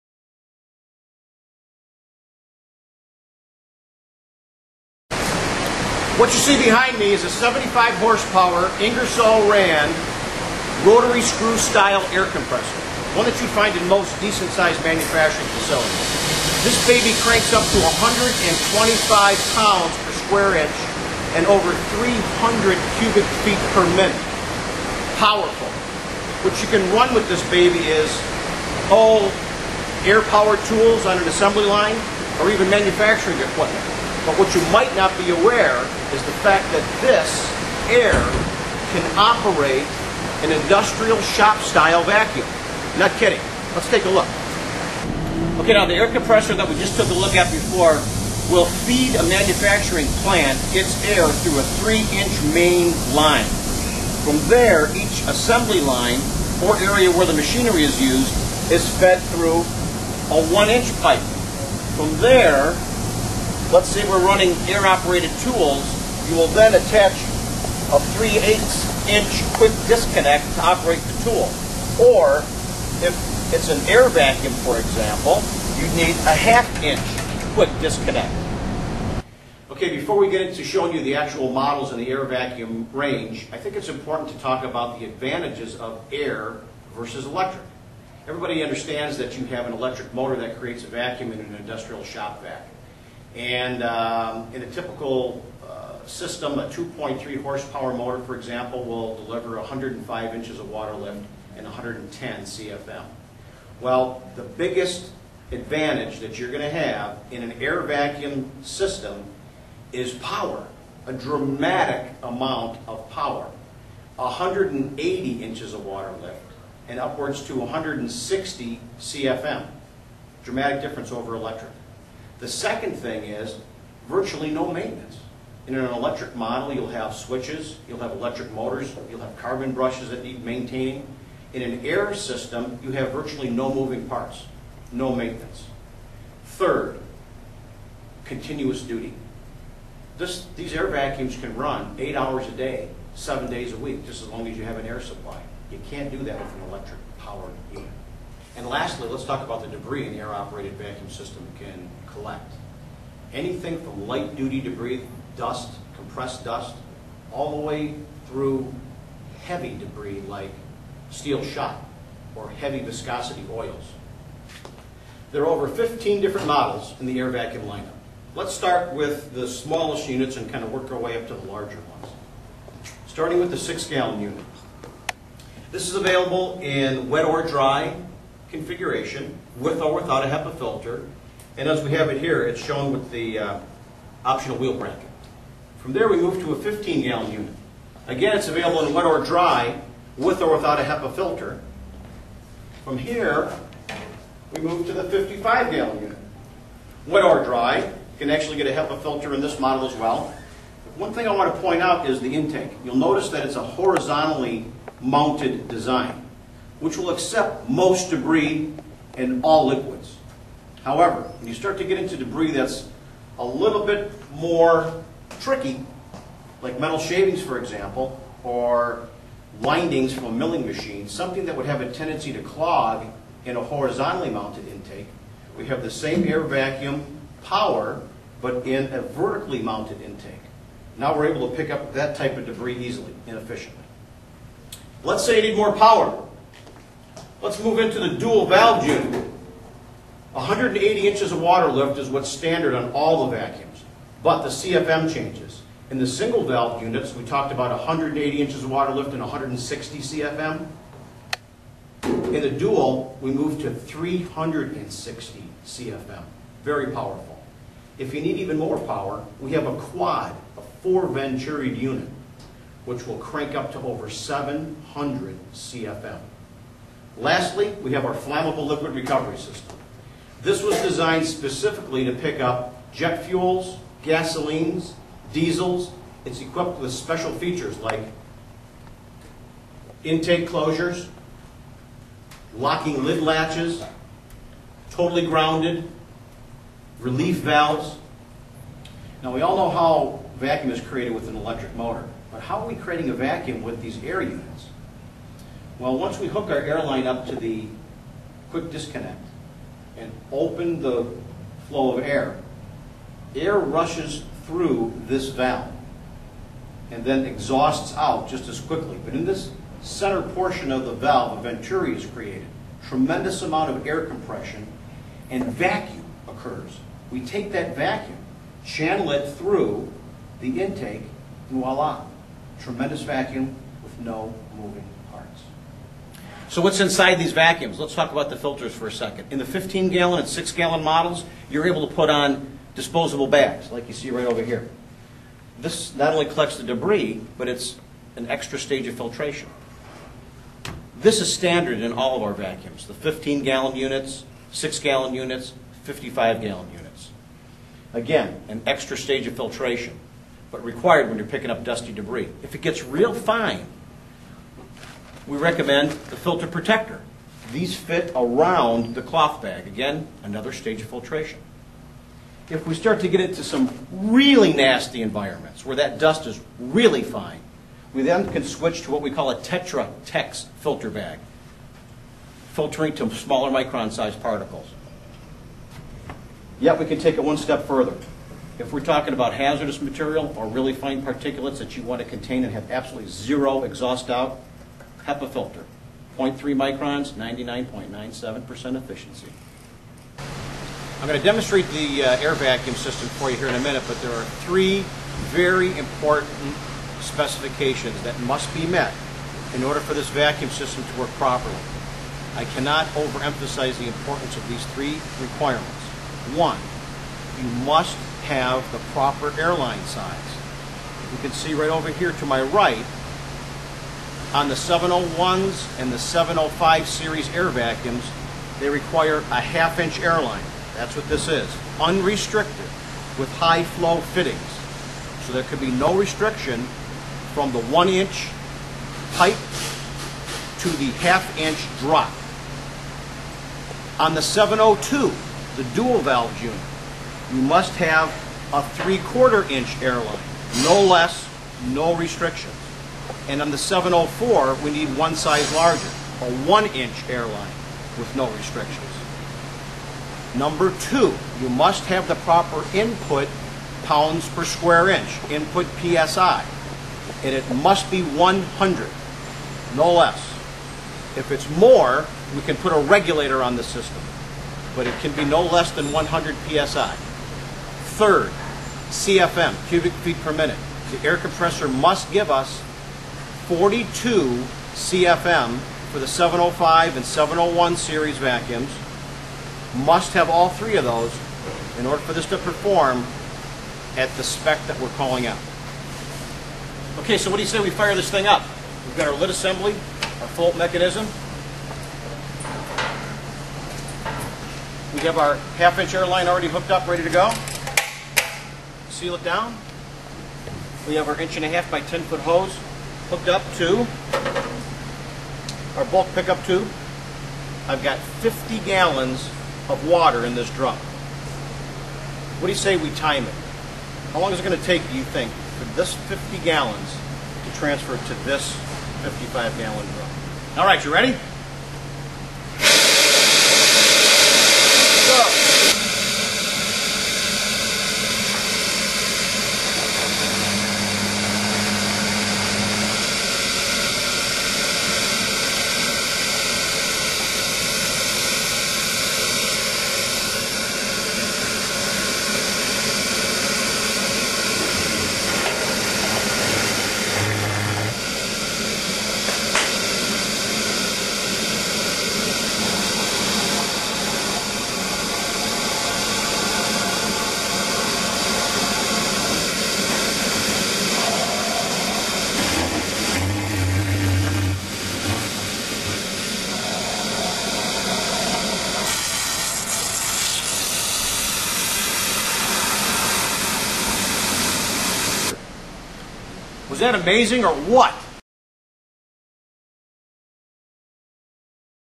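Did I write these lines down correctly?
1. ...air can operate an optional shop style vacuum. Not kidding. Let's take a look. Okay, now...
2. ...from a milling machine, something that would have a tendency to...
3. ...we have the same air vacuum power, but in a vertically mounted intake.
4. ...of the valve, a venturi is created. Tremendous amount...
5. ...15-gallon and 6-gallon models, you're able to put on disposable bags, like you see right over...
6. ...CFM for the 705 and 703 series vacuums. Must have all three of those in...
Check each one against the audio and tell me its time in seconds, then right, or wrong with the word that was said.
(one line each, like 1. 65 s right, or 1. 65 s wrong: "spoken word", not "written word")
1. 37 s wrong: "industrial", not "optional"
2. 220 s right
3. 225 s right
4. 310 s right
5. 329 s right
6. 474 s wrong: "701", not "703".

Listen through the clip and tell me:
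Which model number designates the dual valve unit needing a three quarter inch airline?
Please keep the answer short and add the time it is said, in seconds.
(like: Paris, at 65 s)
702, at 434 s.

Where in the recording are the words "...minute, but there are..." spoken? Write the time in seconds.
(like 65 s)
393 s.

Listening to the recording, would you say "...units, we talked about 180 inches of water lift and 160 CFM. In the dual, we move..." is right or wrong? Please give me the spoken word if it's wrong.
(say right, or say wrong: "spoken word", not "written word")
right.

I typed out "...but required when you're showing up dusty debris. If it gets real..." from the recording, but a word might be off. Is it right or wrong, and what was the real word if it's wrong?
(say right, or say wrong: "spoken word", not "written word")
wrong: "picking", not "showing".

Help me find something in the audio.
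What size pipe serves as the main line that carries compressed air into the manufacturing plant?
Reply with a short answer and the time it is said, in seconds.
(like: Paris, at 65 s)
3 inch, at 51 s.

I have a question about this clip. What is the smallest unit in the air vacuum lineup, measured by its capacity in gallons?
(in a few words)
6 gallon.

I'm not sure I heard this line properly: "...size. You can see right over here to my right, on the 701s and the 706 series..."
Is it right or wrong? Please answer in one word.
wrong.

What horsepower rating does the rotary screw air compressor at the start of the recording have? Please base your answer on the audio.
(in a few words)
75.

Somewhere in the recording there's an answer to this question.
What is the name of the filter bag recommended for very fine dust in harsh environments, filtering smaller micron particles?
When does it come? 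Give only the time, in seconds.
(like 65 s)
369 s.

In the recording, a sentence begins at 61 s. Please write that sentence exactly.
From there, let's say we're running air-operated tools, you will then attach a 3 8 inch quick disconnect to operate the tool.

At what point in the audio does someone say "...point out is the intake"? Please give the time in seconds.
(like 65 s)
201 s.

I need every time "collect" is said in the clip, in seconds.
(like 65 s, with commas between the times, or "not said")
152 s, 336 s.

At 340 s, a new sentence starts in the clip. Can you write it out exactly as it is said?
This is standard in all of our vacuums, the 15-gallon units, 6-gallon units, 55-gallon units.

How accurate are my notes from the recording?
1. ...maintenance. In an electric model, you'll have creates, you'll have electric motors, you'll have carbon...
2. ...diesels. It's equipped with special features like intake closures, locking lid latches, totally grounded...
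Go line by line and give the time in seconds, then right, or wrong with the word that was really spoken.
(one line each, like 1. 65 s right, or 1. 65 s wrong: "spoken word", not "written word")
1. 124 s wrong: "switches", not "creates"
2. 275 s right.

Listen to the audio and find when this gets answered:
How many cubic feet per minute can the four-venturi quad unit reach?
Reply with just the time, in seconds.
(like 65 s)
263 s.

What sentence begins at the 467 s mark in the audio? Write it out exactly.
Third, CFM, cubic feet per minute.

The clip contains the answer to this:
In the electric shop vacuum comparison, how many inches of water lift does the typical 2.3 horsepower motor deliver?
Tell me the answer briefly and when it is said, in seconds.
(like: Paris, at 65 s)
105, at 99 s.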